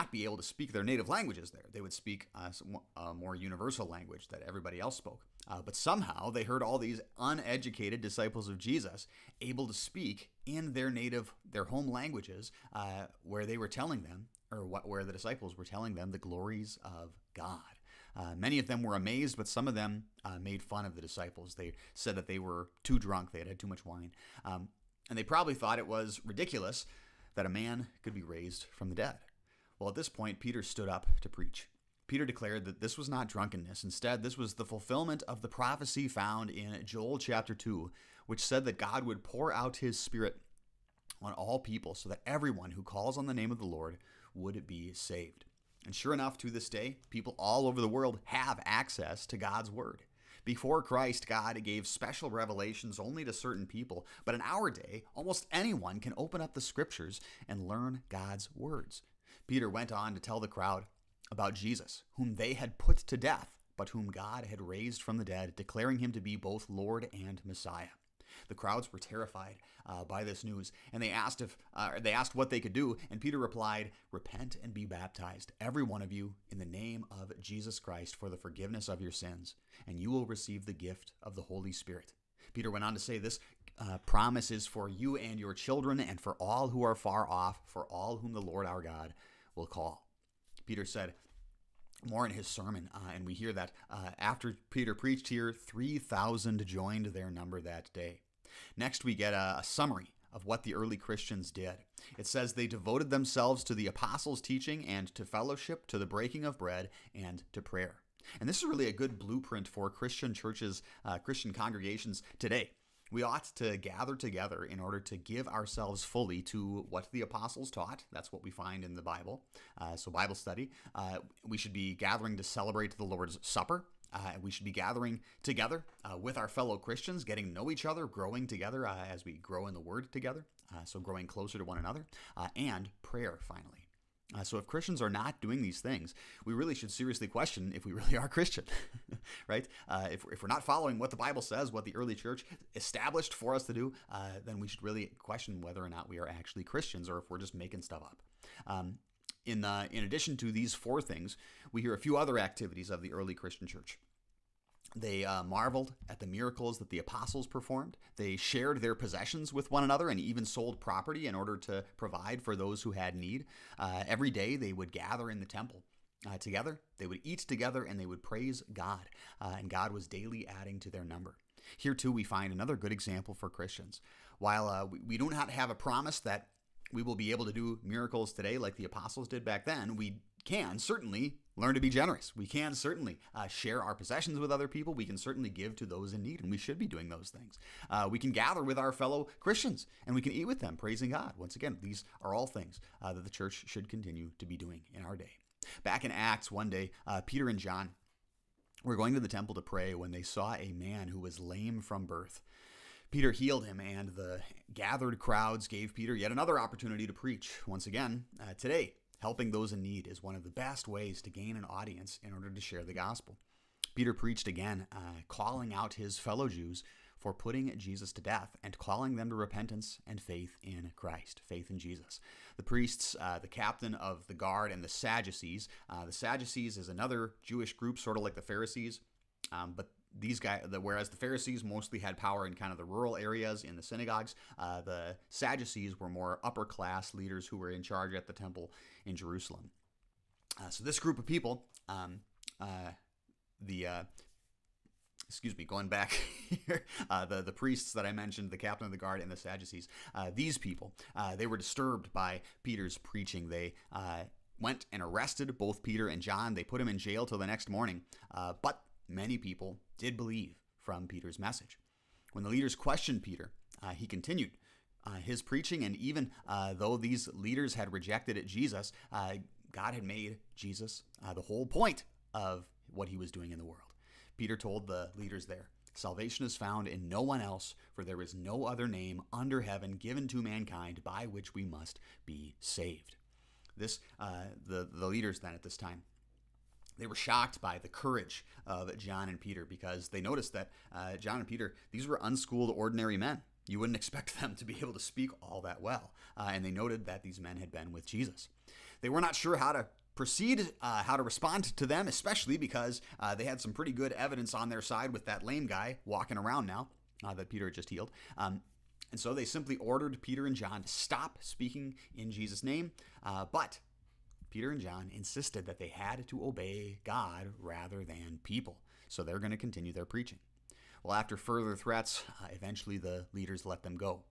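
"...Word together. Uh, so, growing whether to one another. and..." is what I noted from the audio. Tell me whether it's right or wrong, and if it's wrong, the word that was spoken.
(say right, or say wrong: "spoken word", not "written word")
wrong: "closer", not "whether".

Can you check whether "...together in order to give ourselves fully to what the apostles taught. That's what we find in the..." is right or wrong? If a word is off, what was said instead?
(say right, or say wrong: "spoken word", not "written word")
right.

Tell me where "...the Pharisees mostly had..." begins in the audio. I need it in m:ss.
3:51.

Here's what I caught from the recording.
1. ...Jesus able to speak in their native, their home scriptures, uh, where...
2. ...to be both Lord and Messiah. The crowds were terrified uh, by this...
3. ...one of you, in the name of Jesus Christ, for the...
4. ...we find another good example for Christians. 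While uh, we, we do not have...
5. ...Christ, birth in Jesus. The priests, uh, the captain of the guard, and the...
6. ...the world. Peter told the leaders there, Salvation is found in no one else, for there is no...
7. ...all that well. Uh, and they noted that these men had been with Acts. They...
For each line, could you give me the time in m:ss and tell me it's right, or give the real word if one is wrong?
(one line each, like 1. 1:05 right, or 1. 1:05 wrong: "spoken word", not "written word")
1. 0:08 wrong: "languages", not "scriptures"
2. 1:06 right
3. 1:15 right
4. 2:52 right
5. 3:40 wrong: "faith", not "birth"
6. 4:33 right
7. 4:55 wrong: "Jesus", not "Acts".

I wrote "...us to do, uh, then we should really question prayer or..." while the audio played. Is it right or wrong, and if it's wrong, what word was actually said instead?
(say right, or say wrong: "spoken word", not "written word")
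wrong: "whether", not "prayer".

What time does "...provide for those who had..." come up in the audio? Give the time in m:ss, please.
2:41.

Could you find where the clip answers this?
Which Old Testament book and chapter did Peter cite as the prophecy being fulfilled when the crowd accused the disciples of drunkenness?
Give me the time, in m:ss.
0:36.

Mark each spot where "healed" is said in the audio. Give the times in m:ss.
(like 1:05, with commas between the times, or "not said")
3:23, 5:07.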